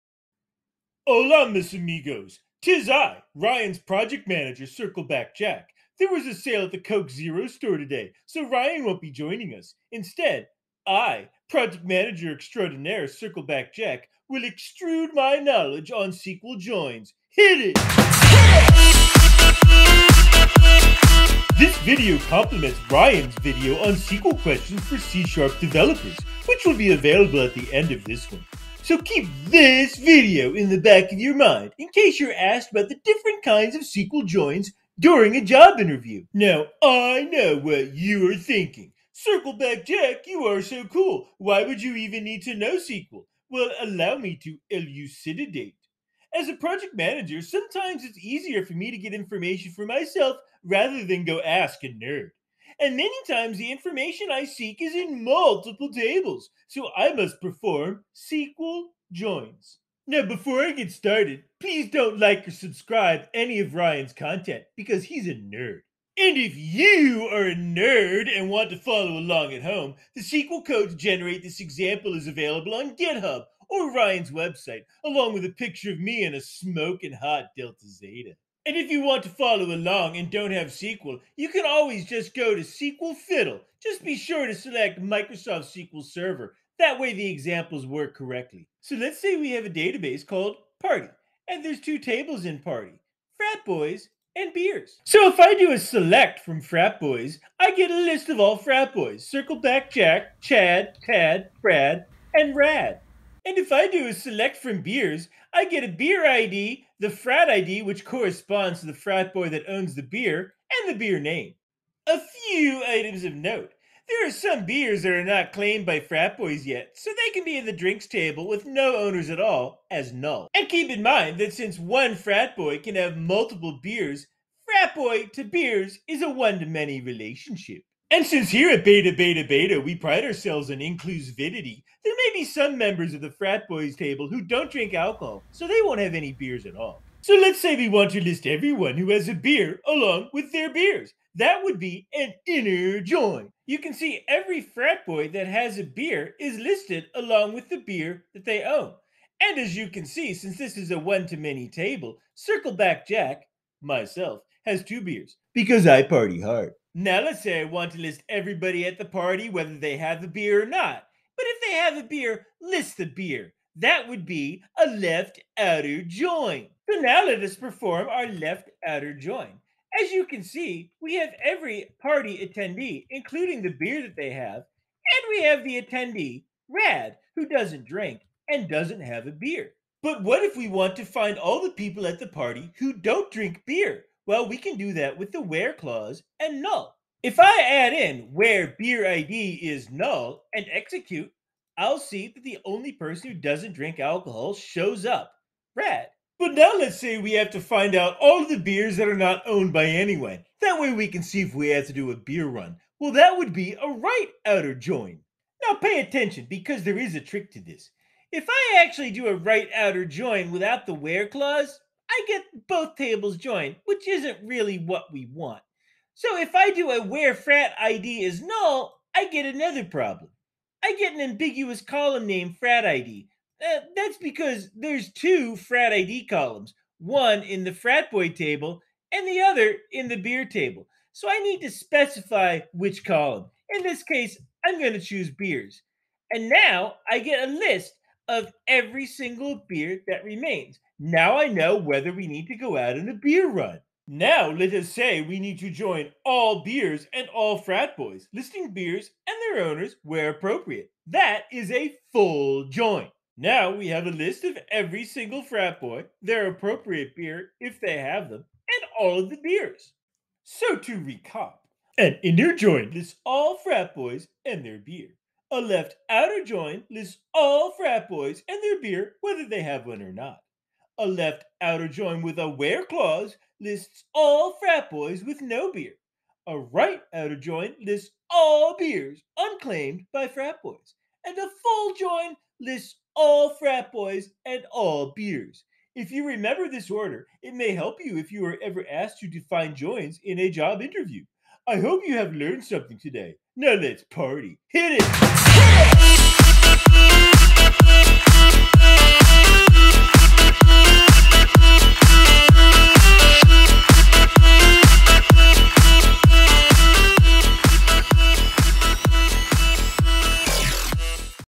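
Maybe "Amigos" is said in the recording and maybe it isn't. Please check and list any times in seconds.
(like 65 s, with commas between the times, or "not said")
1 s.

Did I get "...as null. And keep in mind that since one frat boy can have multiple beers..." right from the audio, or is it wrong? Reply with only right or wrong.
right.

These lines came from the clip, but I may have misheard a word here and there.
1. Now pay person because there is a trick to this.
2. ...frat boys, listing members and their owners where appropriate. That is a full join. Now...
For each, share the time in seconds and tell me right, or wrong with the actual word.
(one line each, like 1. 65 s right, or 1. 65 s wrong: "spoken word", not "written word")
1. 205 s wrong: "attention", not "person"
2. 247 s wrong: "beers", not "members".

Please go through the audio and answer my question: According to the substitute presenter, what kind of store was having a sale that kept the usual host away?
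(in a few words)
Coke Zero store.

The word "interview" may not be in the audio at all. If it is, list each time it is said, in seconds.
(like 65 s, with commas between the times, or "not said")
35 s, 290 s.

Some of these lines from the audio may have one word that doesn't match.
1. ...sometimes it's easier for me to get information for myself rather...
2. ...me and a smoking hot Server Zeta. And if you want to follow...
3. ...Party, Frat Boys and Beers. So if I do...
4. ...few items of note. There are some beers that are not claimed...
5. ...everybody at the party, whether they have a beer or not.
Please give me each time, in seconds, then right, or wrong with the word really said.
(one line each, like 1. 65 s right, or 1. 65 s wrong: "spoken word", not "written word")
1. 47 s right
2. 75 s wrong: "Delta", not "Server"
3. 92 s right
4. 112 s right
5. 158 s right.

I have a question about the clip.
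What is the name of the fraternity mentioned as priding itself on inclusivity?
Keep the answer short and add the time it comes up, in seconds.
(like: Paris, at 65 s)
Beta Beta Beta, at 128 s.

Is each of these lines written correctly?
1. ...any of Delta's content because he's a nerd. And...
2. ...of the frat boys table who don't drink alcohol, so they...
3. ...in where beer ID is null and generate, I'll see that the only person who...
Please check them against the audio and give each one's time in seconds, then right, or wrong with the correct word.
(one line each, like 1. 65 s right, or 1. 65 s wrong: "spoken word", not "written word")
1. 63 s wrong: "Ryan", not "Delta"
2. 133 s right
3. 187 s wrong: "execute", not "generate".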